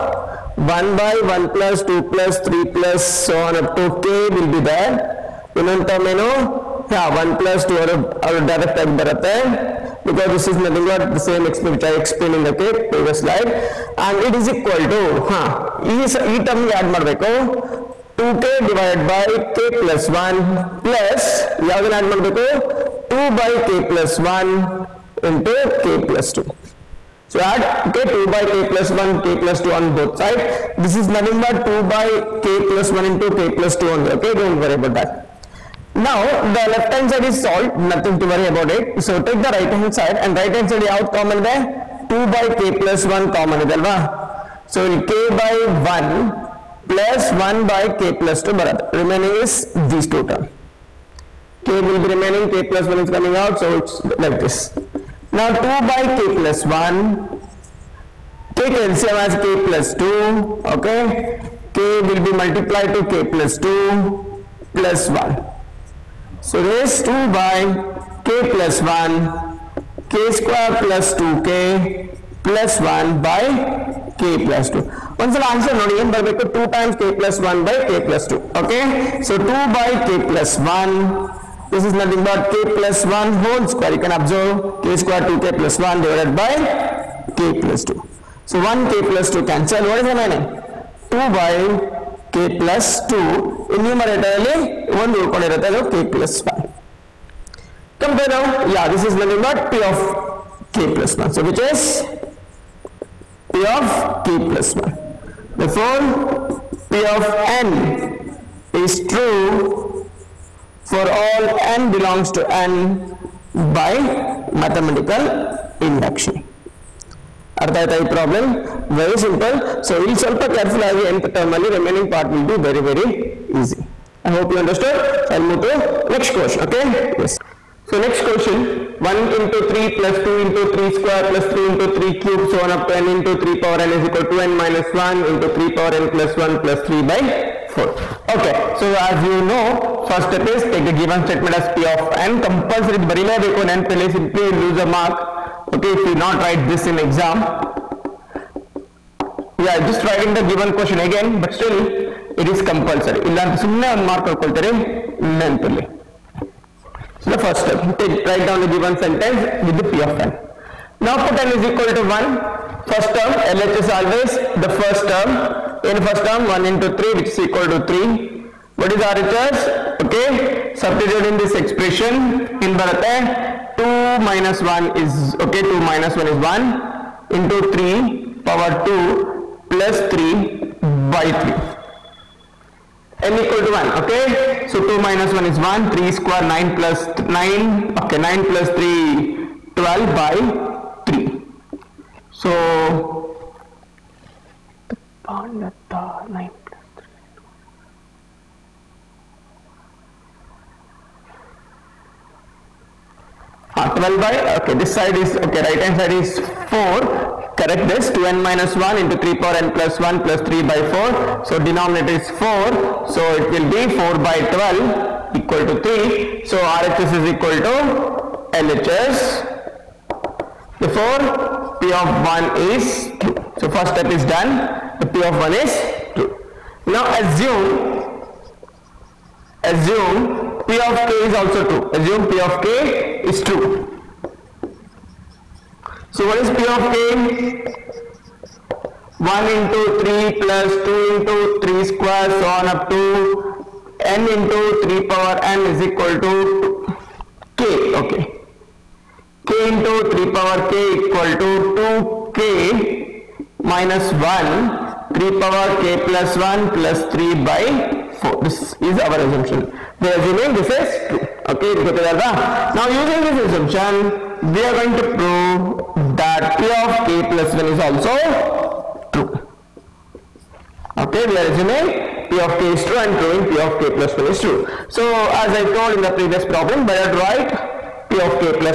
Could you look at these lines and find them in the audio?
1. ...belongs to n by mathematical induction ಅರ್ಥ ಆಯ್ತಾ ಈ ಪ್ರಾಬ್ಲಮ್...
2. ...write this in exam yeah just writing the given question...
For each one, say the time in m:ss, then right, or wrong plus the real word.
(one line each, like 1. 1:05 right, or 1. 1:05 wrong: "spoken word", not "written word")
1. 1:51 right
2. 2:26 right.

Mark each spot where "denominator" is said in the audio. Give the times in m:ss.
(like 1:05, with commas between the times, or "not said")
3:31.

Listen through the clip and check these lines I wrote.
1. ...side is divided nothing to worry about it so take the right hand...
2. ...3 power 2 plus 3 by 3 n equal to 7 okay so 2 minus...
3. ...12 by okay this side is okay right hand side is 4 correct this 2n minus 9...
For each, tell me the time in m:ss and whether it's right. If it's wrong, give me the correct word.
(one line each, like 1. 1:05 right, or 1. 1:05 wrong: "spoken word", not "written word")
1. 0:37 wrong: "solved", not "divided"
2. 2:57 wrong: "1", not "7"
3. 3:23 wrong: "1", not "9".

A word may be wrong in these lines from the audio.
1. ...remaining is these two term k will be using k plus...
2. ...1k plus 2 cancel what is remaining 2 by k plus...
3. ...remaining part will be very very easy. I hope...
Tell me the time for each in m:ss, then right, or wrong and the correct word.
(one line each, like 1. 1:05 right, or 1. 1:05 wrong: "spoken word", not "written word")
1. 0:49 wrong: "remaining", not "using"
2. 1:28 right
3. 2:01 right.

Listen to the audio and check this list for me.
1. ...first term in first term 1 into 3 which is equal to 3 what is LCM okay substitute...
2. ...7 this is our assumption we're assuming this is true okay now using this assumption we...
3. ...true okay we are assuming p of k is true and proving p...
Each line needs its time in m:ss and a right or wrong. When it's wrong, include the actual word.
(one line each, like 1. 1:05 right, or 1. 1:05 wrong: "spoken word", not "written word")
1. 2:44 wrong: "RHS", not "LCM"
2. 4:18 wrong: "4", not "7"
3. 4:29 right.